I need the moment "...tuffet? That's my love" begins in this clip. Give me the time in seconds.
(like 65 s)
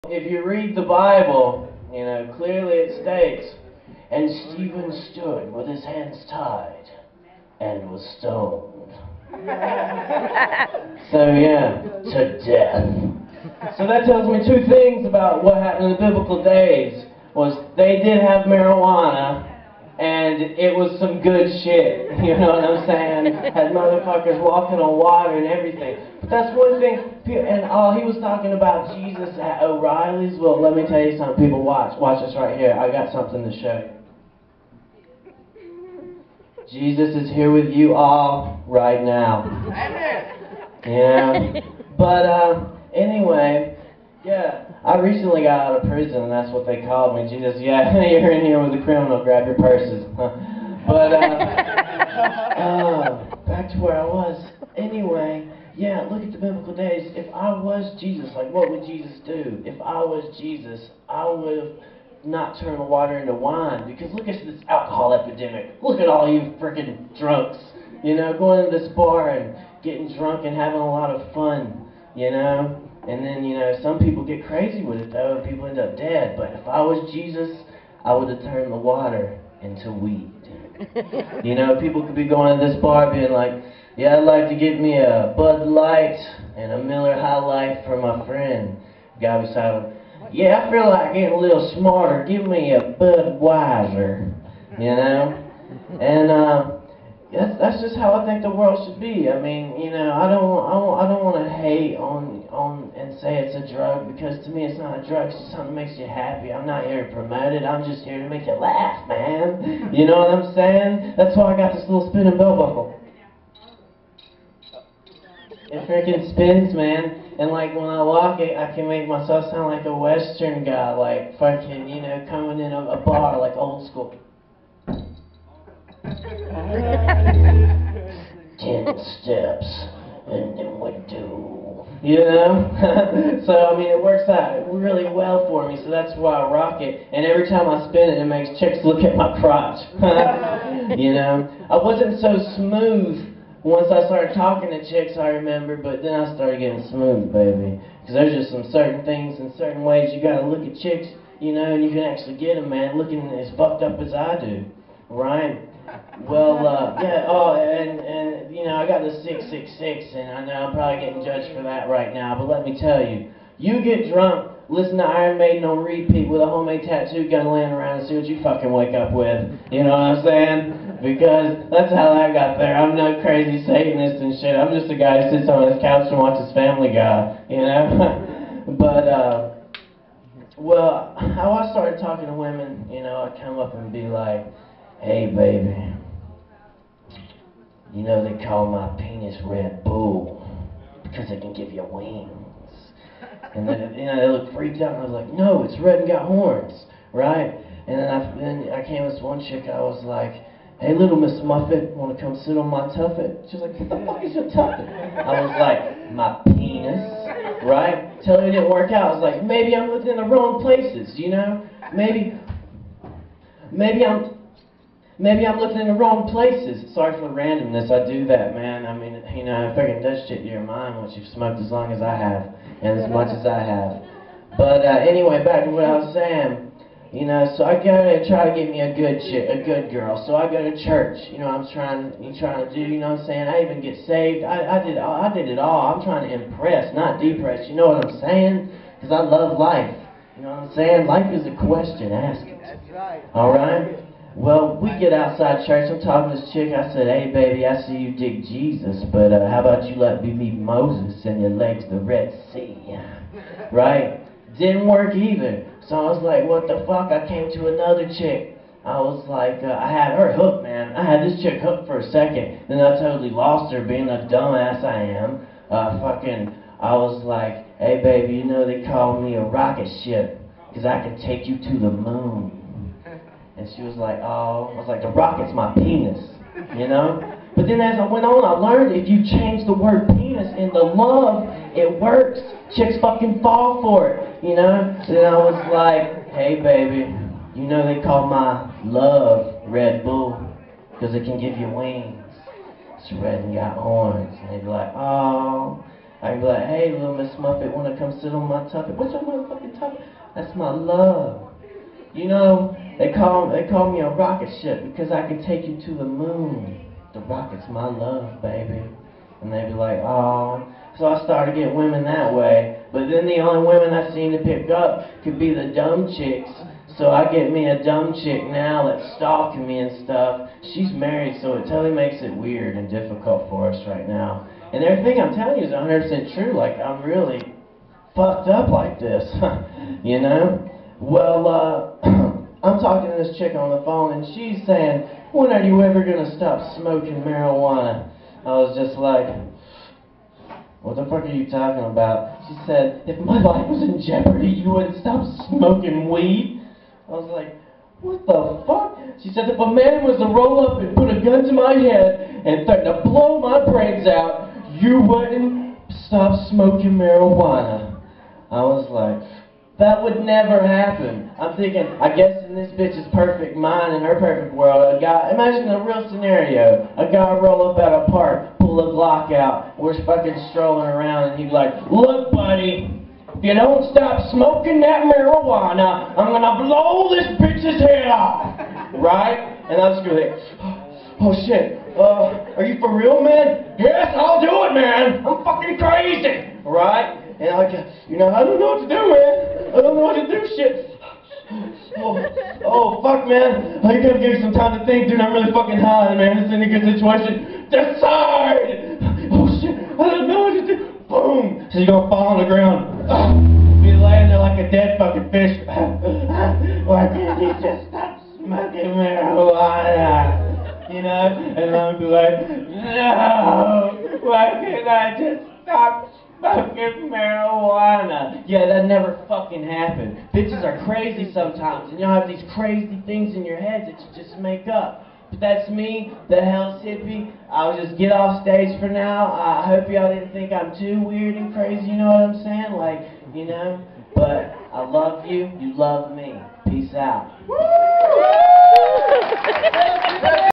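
299 s.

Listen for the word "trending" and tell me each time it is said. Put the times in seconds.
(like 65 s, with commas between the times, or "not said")
not said.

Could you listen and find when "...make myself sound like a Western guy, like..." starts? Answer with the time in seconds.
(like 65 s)
118 s.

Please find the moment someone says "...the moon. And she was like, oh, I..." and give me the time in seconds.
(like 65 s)
271 s.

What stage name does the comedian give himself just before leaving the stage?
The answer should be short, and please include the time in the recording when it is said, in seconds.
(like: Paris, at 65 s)
Hell's Hippie, at 426 s.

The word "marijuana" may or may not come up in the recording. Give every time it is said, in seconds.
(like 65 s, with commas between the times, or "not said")
18 s, 337 s, 356 s, 375 s, 409 s, 417 s.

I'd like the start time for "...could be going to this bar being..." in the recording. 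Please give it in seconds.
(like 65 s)
82 s.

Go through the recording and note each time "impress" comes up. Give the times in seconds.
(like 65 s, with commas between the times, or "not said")
236 s.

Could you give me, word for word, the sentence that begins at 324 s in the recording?
And everything I'm telling you is 100% true.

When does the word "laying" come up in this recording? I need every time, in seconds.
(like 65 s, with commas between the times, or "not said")
167 s, 404 s.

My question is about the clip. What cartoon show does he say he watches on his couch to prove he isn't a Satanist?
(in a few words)
Family Guy.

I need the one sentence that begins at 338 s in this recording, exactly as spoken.
I was just like, what the fuck are you talking about?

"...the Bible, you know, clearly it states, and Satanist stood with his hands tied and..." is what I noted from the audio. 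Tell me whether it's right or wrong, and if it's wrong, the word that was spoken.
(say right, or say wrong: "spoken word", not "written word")
wrong: "Stephen", not "Satanist".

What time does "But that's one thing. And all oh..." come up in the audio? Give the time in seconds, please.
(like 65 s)
26 s.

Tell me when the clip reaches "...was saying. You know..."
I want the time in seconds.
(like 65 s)
225 s.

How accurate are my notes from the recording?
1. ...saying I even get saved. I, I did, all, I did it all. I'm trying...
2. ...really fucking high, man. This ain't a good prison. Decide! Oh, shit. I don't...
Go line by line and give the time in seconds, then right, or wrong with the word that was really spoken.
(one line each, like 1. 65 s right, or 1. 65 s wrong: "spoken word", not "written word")
1. 233 s right
2. 395 s wrong: "situation", not "prison".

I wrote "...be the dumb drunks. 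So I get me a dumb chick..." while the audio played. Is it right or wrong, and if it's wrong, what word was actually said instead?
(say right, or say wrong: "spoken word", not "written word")
wrong: "chicks", not "drunks".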